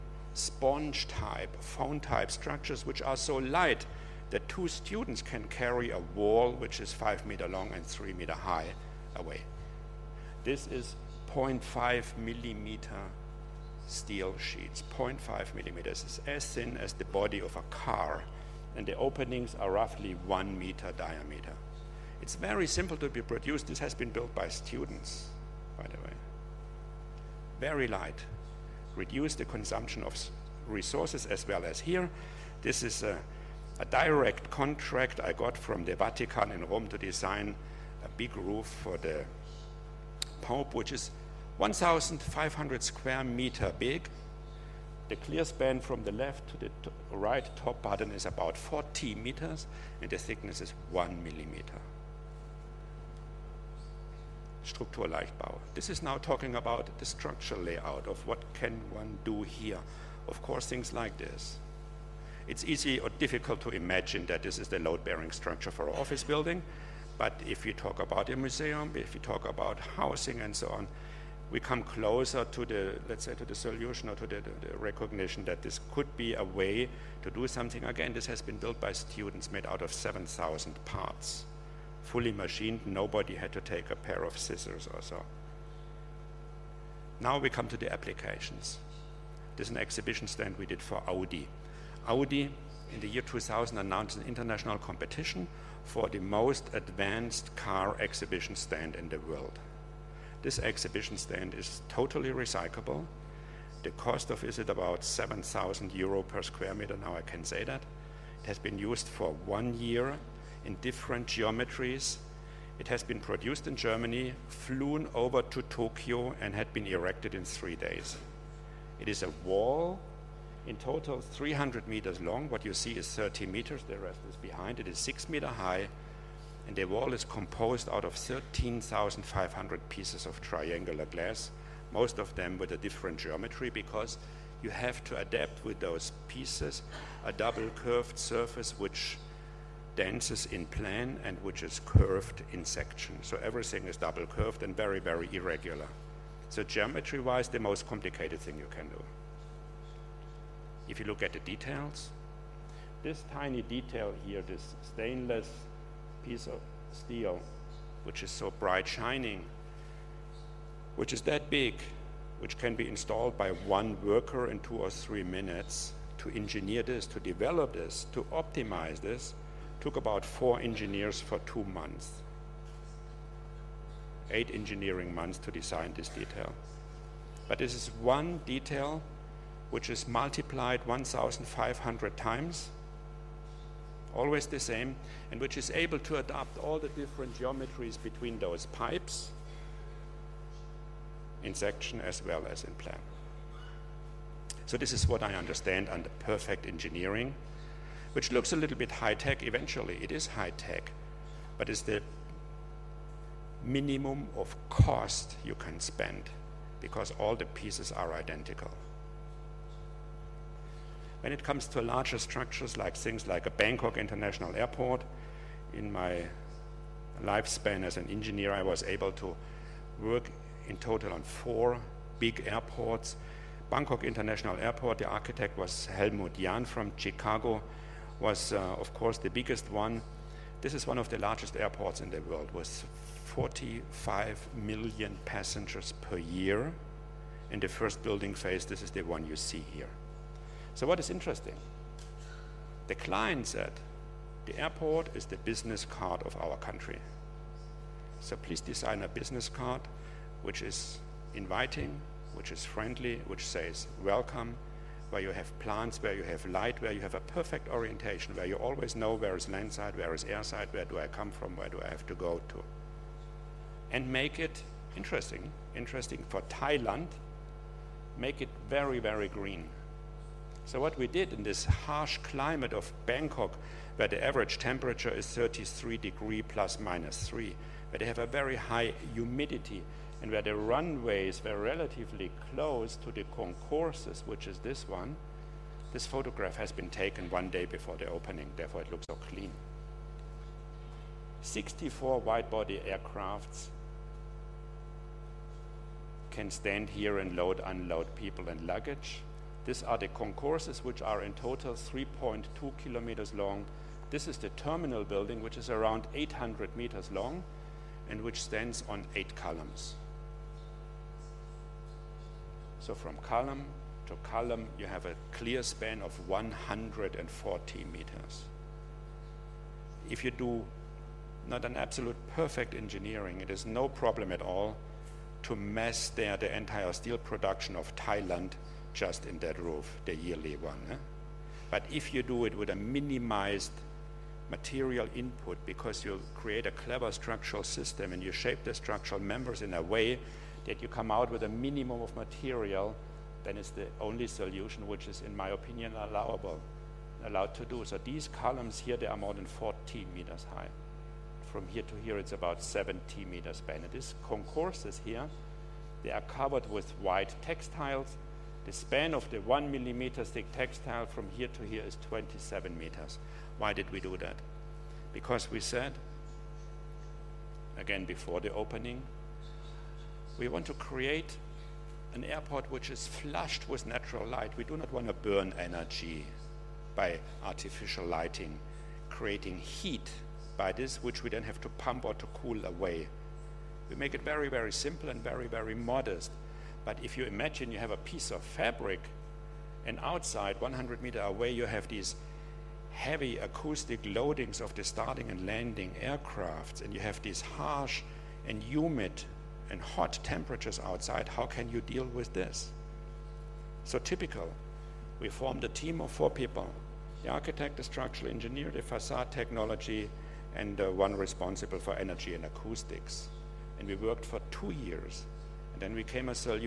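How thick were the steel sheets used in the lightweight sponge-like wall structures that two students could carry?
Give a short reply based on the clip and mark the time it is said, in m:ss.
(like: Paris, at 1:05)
0.5 millimeter, at 0:11.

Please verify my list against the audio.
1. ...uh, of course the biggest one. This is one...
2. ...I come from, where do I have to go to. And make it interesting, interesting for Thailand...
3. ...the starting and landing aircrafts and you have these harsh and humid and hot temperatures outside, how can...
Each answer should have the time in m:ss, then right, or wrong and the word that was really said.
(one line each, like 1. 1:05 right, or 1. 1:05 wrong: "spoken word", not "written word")
1. 3:48 right
2. 4:20 right
3. 6:34 right.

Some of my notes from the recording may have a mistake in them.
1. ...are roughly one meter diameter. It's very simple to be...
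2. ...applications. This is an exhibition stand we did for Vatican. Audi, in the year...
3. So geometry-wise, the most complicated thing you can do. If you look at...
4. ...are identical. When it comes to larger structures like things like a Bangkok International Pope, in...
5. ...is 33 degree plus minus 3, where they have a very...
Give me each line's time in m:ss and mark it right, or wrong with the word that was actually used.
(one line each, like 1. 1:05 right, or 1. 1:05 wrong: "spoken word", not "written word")
1. 0:19 right
2. 1:27 wrong: "Audi", not "Vatican"
3. 2:26 right
4. 3:27 wrong: "Airport", not "Pope"
5. 4:35 right.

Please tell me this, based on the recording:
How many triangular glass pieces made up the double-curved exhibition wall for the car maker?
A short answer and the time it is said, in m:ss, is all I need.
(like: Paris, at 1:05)
13,500, at 2:08.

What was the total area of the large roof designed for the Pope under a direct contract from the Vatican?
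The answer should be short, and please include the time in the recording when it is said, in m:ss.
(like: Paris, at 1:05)
1,500 square meters, at 0:41.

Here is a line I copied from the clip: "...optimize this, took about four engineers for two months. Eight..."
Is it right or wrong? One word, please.
right.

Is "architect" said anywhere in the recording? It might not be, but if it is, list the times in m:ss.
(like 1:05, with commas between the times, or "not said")
3:45, 6:47.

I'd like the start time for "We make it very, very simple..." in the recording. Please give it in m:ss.
6:23.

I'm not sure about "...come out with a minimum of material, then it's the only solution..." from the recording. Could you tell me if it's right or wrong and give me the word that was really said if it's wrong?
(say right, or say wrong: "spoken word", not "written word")
right.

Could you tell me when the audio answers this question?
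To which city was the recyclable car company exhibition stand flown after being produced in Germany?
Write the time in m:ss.
1:55.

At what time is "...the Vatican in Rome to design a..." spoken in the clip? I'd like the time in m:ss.
0:35.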